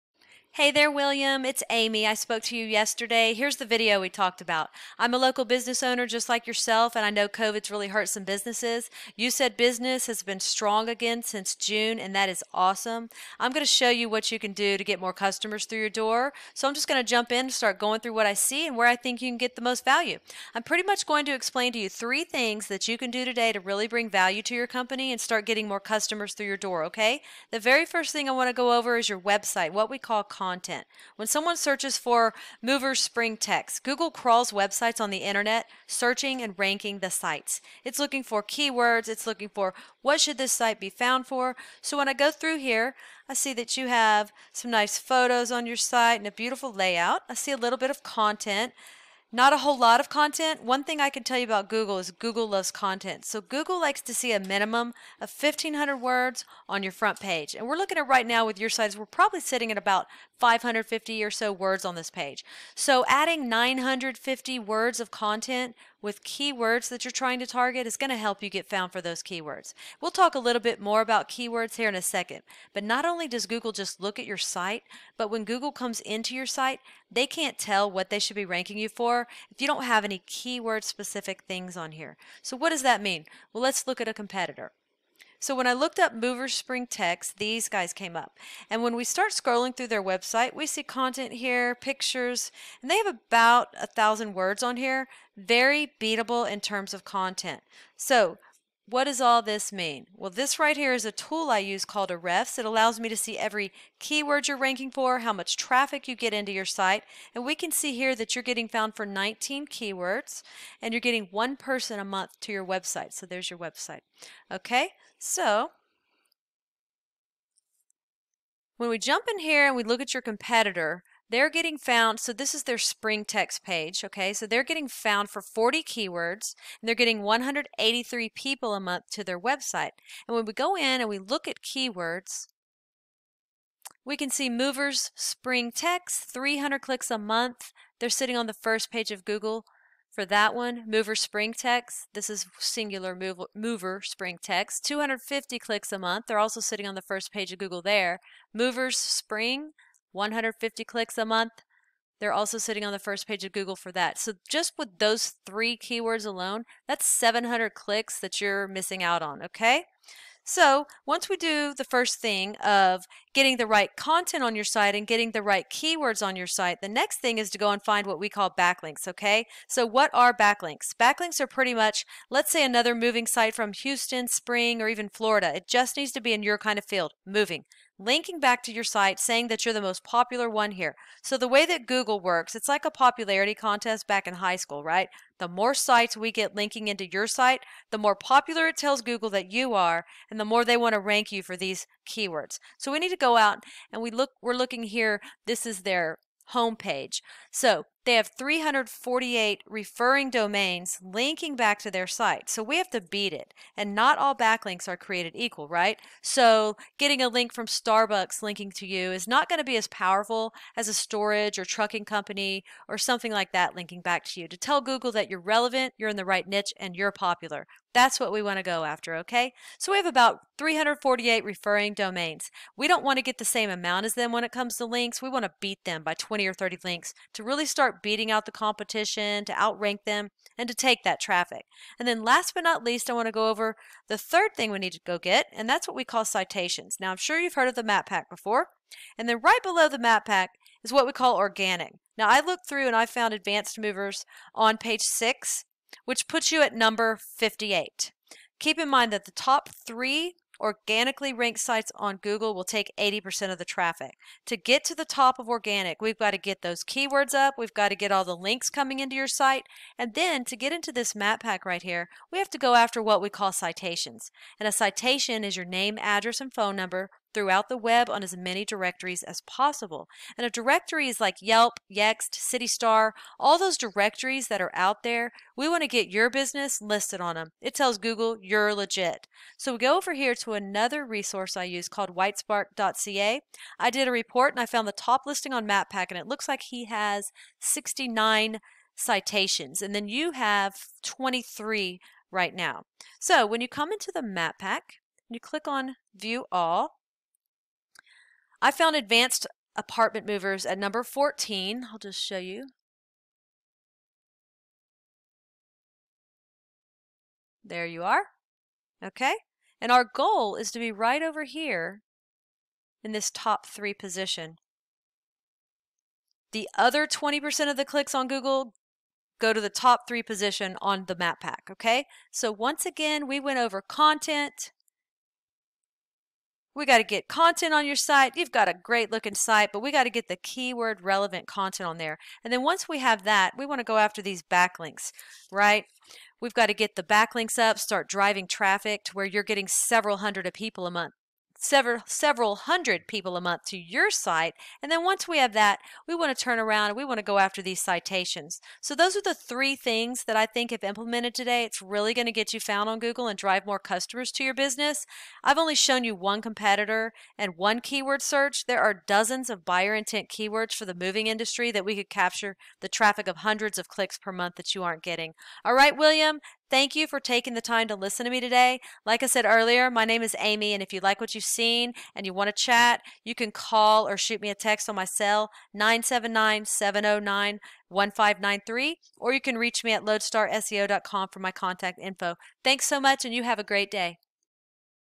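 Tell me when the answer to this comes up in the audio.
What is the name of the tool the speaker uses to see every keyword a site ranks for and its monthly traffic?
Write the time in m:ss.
1:42.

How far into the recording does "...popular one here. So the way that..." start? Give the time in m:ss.
3:00.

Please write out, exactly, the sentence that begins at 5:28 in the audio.
You've got a great looking site, but we got to get the keyword relevant content on there.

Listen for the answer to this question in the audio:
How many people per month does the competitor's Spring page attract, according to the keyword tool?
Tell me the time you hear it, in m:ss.
2:07.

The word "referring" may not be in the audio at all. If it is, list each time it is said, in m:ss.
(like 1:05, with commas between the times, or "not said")
3:19, 3:41.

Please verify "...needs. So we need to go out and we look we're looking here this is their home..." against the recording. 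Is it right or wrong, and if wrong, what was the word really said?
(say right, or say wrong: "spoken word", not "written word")
wrong: "keywords", not "needs".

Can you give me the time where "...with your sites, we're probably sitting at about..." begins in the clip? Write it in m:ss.
0:58.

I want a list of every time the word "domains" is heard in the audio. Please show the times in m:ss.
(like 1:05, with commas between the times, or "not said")
3:20, 3:41.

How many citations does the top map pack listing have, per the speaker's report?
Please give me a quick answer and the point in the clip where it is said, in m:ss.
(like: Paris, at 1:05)
69, at 4:47.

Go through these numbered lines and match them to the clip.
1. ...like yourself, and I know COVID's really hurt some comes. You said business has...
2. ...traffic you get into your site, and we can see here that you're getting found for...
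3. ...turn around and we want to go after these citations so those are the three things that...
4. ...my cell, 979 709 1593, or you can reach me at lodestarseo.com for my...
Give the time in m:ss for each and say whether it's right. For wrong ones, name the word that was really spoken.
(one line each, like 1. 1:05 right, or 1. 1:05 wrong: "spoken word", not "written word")
1. 0:06 wrong: "businesses", not "comes"
2. 1:45 right
3. 5:46 right
4. 6:14 right.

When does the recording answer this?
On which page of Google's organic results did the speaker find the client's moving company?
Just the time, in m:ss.
4:04.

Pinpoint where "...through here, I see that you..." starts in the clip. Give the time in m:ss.
0:42.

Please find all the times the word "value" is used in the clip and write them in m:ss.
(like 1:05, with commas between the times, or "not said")
0:19, 0:24.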